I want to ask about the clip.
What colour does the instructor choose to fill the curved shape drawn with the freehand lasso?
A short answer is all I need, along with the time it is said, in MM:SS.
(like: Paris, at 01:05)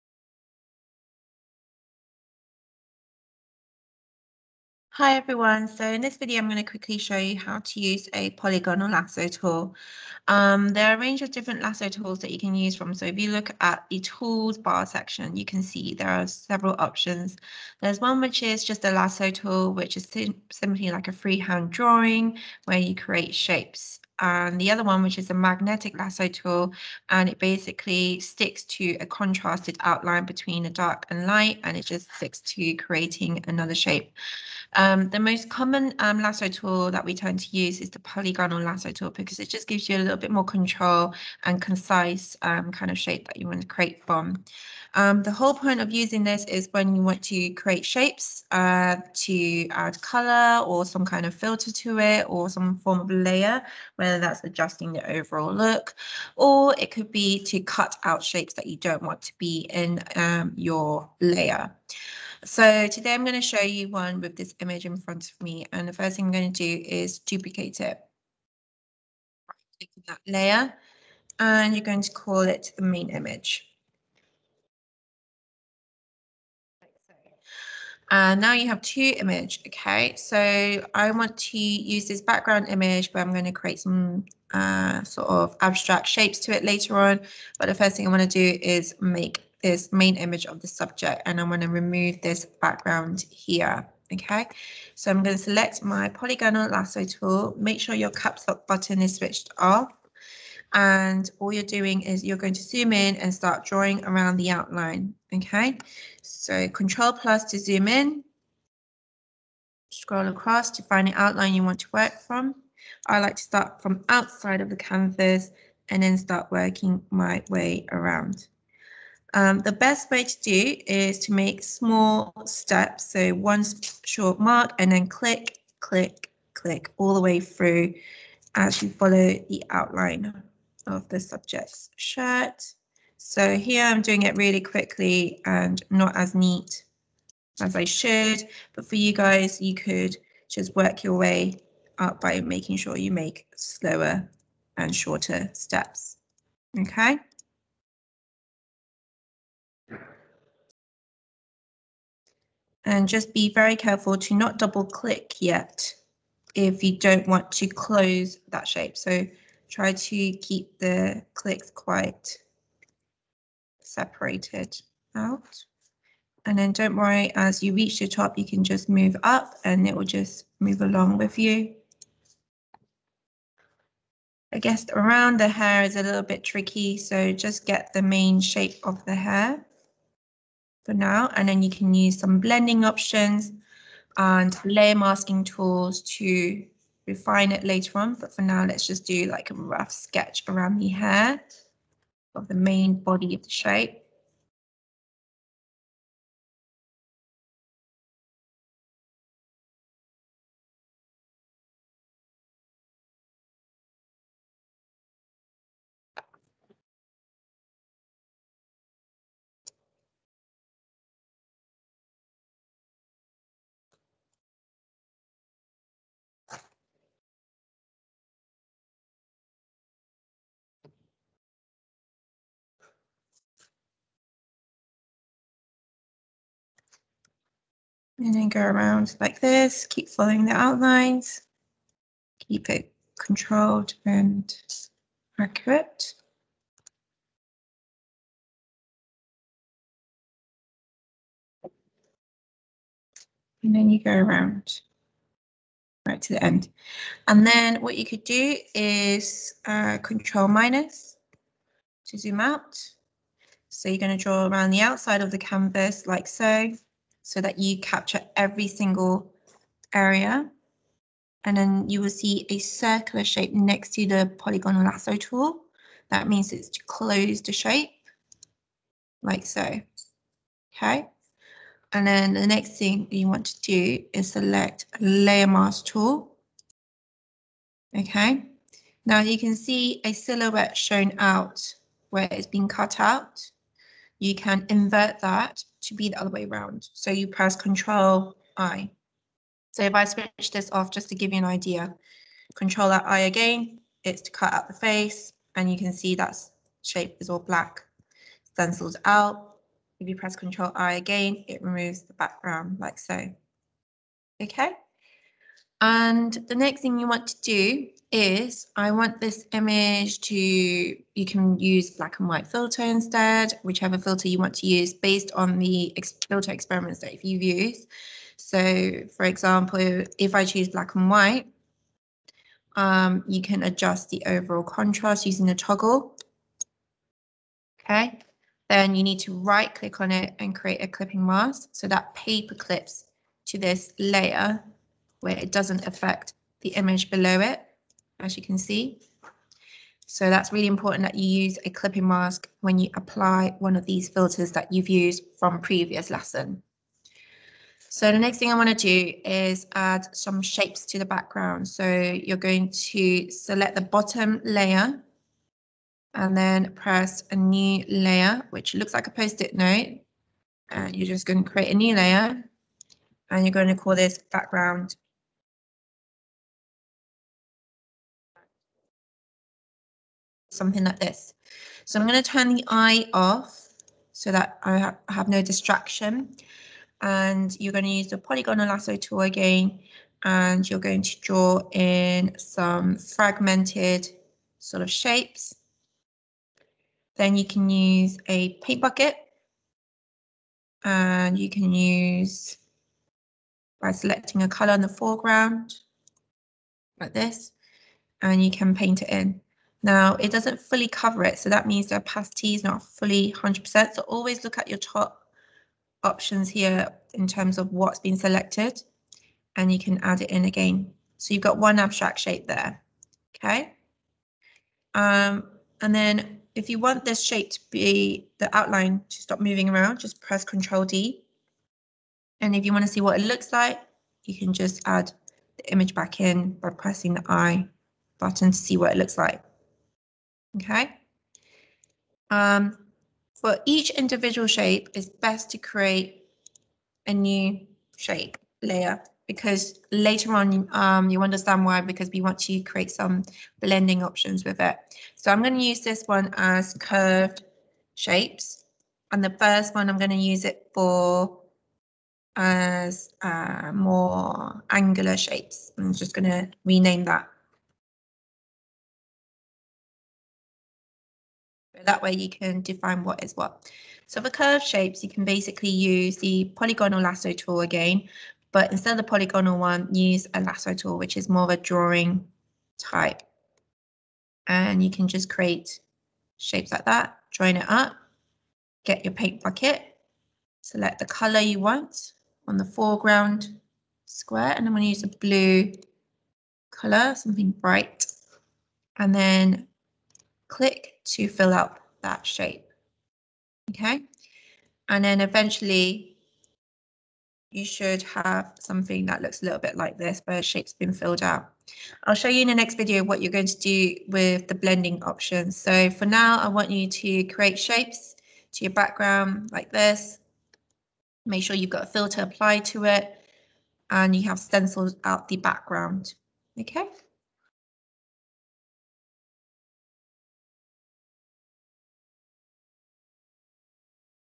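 blue, at 08:05.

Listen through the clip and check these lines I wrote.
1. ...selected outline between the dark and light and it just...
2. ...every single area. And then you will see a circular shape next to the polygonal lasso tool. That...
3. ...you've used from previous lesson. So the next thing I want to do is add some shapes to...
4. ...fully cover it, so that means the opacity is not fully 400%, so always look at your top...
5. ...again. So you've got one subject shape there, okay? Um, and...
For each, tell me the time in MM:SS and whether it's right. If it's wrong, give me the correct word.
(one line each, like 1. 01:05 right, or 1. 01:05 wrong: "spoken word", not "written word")
1. 00:29 wrong: "contrasted", not "selected"
2. 04:18 right
3. 05:44 right
4. 06:40 wrong: "100", not "400"
5. 06:50 wrong: "abstract", not "subject".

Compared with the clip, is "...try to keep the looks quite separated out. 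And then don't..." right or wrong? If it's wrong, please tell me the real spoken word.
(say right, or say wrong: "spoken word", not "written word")
wrong: "clicks", not "looks".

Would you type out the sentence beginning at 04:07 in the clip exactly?
And then what you could do is uh, control minus to zoom out.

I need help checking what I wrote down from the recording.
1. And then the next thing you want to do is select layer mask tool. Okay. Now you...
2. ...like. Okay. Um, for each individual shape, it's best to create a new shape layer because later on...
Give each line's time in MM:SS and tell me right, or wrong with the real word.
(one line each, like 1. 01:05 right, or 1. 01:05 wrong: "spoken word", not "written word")
1. 04:31 right
2. 07:09 right.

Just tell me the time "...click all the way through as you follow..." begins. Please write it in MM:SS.
02:06.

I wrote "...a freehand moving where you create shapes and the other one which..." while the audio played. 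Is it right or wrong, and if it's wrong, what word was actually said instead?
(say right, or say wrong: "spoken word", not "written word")
wrong: "drawing", not "moving".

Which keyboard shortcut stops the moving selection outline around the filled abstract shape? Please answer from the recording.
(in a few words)
Control D.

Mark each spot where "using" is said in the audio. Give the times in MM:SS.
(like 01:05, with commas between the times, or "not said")
00:45, 05:25.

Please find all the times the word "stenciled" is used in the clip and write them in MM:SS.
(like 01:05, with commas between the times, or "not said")
04:58, 08:34.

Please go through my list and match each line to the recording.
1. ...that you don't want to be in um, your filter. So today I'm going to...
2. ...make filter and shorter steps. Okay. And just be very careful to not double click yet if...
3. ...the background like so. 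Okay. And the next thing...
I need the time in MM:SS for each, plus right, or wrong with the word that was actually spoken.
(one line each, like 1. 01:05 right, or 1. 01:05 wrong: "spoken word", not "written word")
1. 00:58 wrong: "layer", not "filter"
2. 02:23 wrong: "slower", not "filter"
3. 05:02 right.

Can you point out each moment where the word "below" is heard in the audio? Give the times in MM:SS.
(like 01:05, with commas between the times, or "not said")
05:37.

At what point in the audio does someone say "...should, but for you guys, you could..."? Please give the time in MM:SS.
02:17.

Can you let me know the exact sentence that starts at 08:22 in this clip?
I'll show you in the next video what you're going to do with the blending options.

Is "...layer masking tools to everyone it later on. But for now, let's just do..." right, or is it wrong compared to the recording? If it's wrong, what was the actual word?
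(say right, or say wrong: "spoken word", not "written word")
wrong: "refine", not "everyone".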